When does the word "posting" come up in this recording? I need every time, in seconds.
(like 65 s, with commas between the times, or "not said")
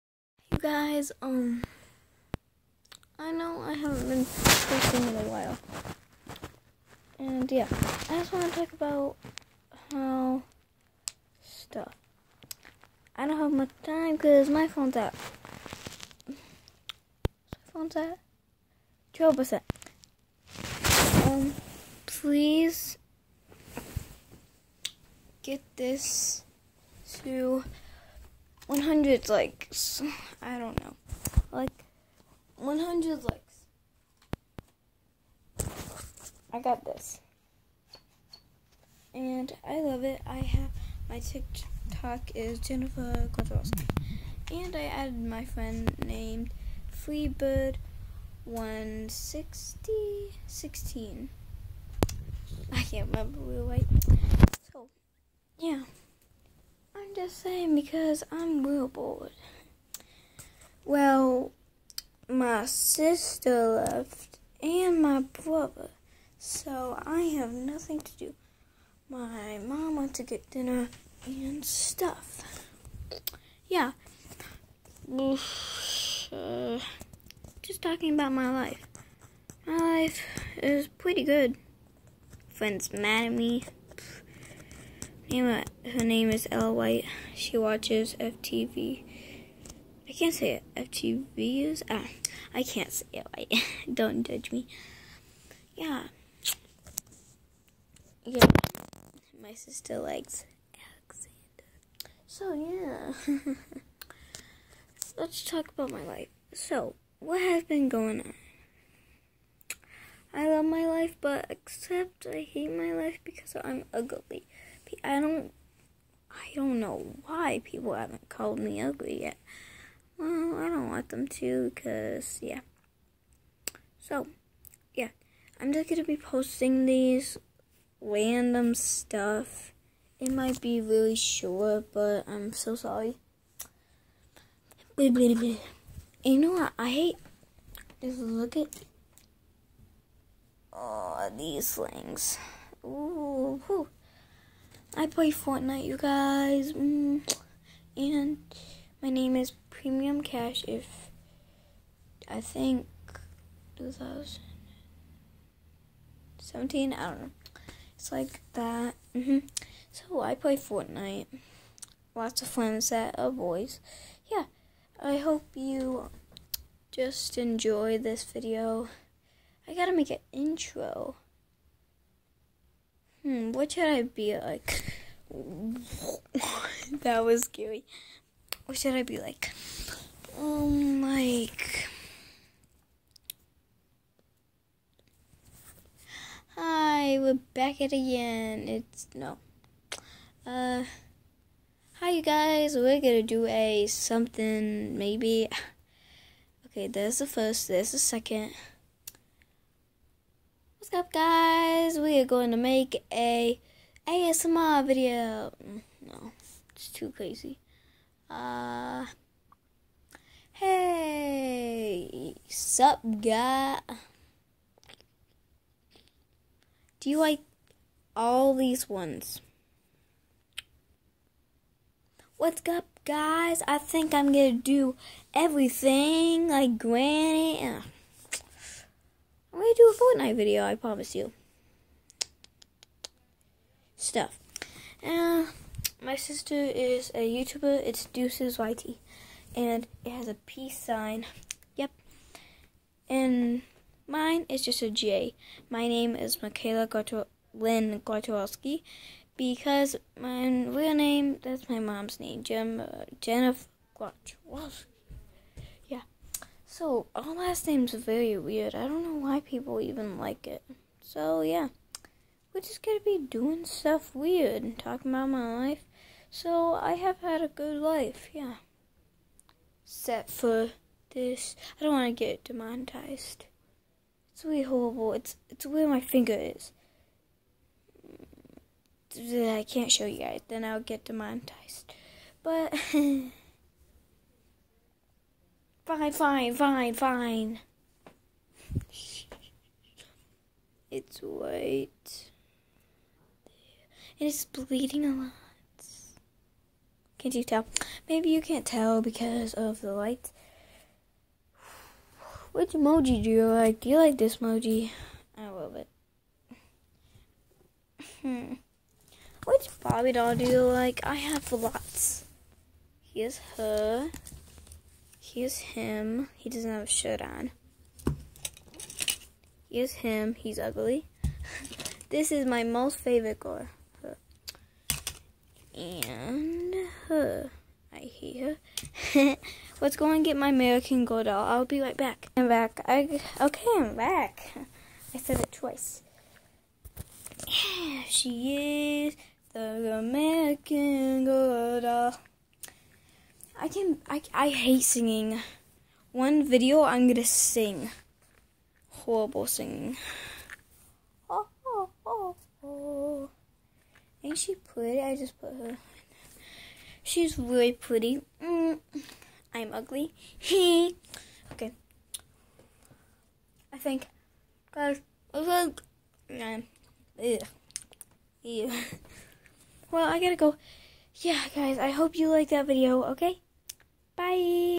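4 s, 126 s.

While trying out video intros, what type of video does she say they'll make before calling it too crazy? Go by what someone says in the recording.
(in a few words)
ASMR.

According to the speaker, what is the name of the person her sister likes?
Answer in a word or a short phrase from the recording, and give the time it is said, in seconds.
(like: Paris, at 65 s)
Alexander, at 102 s.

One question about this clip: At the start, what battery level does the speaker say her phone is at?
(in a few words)
12%.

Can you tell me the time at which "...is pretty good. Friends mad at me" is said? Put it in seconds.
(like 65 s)
80 s.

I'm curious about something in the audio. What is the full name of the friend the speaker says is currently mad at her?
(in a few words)
Ella White.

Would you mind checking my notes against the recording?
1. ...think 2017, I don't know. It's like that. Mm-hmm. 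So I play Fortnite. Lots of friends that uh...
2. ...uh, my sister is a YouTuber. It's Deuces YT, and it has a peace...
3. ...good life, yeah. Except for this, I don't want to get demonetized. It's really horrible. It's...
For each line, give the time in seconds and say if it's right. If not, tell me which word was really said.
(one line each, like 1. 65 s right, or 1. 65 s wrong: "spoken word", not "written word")
1. 152 s right
2. 235 s right
3. 267 s right.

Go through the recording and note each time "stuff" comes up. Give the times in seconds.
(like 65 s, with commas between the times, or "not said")
11 s, 71 s, 128 s, 234 s, 263 s.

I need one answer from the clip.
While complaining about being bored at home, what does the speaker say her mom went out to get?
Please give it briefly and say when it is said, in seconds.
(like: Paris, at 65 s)
dinner, at 70 s.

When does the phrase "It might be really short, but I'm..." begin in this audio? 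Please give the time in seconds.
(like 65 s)
130 s.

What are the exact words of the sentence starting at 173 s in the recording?
Hmm, what should I be like?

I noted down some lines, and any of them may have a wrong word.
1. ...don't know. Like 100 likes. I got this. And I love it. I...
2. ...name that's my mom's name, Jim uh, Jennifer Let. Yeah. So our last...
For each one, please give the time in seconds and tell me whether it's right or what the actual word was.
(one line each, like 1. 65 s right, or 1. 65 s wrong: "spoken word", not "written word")
1. 30 s right
2. 250 s wrong: "Grochowalski", not "Let".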